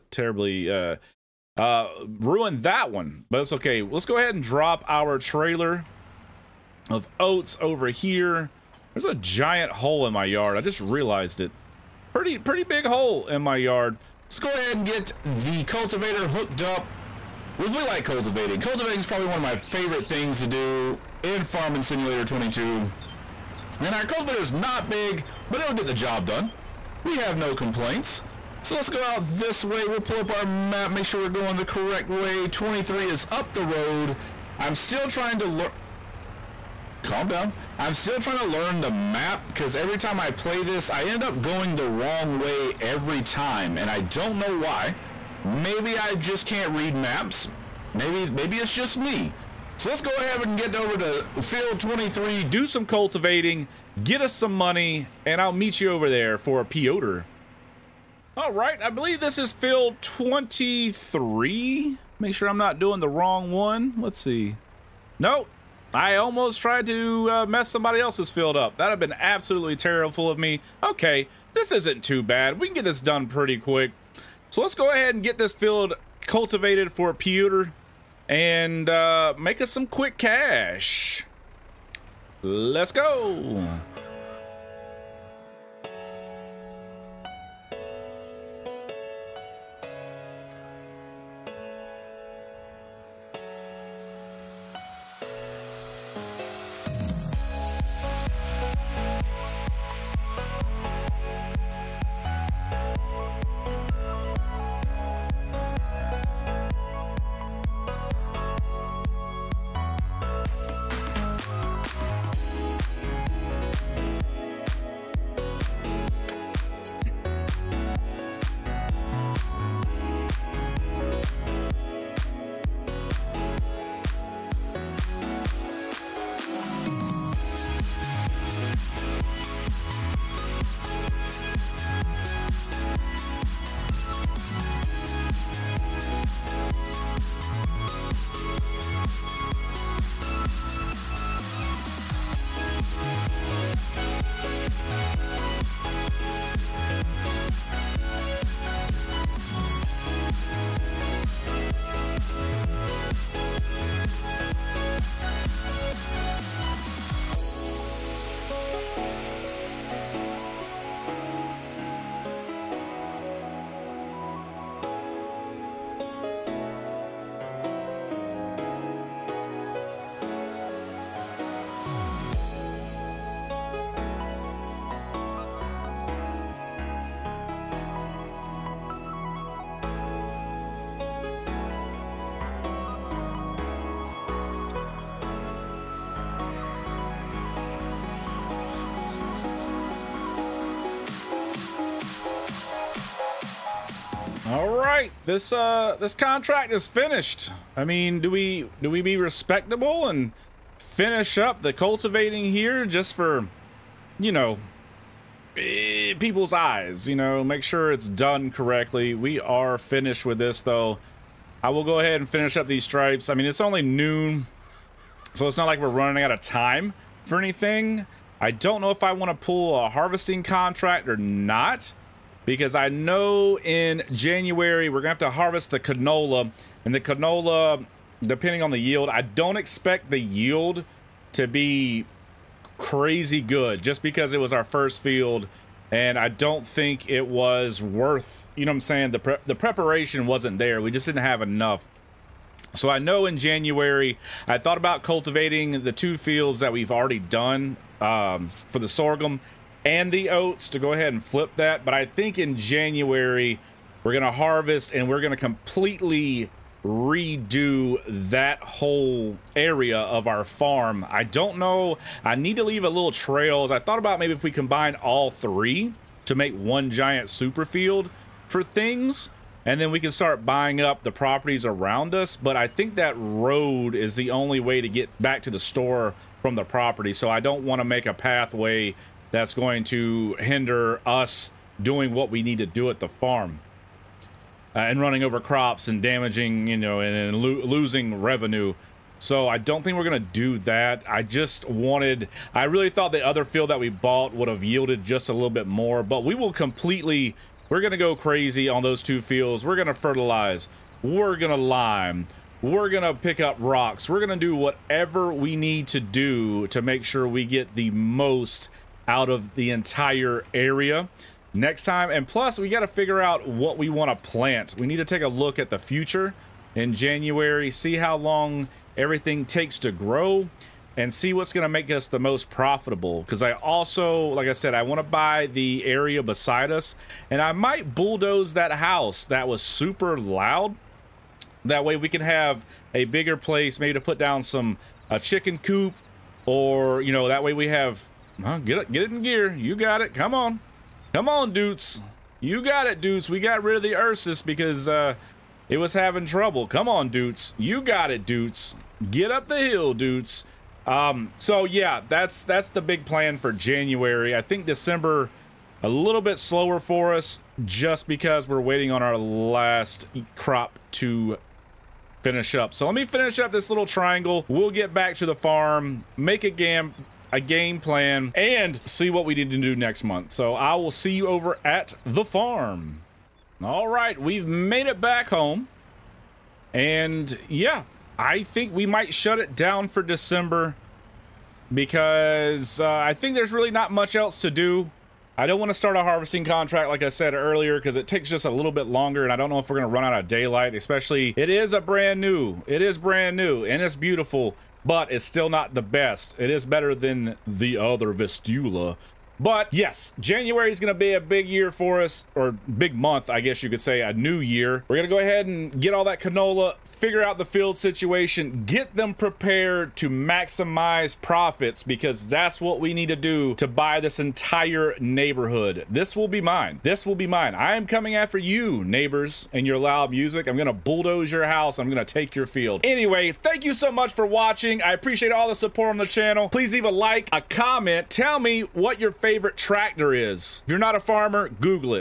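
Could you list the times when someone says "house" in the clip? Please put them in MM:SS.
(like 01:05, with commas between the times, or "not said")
05:28, 07:01.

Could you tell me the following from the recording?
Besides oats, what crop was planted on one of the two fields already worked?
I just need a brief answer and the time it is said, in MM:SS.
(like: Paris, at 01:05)
Sorghum, at 04:08.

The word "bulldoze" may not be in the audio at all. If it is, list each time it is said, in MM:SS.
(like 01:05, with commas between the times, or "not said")
05:27, 07:00.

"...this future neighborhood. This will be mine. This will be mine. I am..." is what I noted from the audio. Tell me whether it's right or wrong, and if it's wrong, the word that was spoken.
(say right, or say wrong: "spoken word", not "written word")
wrong: "entire", not "future".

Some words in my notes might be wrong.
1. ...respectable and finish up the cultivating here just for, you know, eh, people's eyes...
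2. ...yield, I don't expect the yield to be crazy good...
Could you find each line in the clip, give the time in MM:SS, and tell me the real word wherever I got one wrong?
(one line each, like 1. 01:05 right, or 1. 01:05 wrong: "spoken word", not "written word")
1. 03:19 right
2. 03:48 right.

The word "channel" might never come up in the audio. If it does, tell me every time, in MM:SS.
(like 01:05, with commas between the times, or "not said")
07:06.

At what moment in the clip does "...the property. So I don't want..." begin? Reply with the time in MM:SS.
04:36.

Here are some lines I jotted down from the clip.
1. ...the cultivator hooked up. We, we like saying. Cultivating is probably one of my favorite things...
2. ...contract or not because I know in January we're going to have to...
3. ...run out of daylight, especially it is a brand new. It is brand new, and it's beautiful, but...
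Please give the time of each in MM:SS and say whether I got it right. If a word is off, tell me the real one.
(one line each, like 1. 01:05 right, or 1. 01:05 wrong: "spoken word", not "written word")
1. 00:15 wrong: "cultivating", not "saying"
2. 03:40 right
3. 06:29 right.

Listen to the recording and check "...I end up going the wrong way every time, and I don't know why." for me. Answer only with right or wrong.
right.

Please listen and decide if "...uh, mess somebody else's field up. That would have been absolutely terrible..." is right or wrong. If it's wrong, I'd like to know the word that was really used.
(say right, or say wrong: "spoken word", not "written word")
right.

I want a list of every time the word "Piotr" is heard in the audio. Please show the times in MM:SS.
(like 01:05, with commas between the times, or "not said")
00:56, 01:17.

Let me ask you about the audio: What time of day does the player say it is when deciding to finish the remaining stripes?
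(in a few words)
Noon.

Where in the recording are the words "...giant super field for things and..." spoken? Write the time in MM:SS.
04:26.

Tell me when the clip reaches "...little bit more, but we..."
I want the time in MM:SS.
04:55.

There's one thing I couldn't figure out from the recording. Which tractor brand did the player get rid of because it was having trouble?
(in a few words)
Ursus.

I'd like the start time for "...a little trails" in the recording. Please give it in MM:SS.
04:22.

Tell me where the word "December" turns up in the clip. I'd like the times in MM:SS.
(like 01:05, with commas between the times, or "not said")
05:54, 06:20.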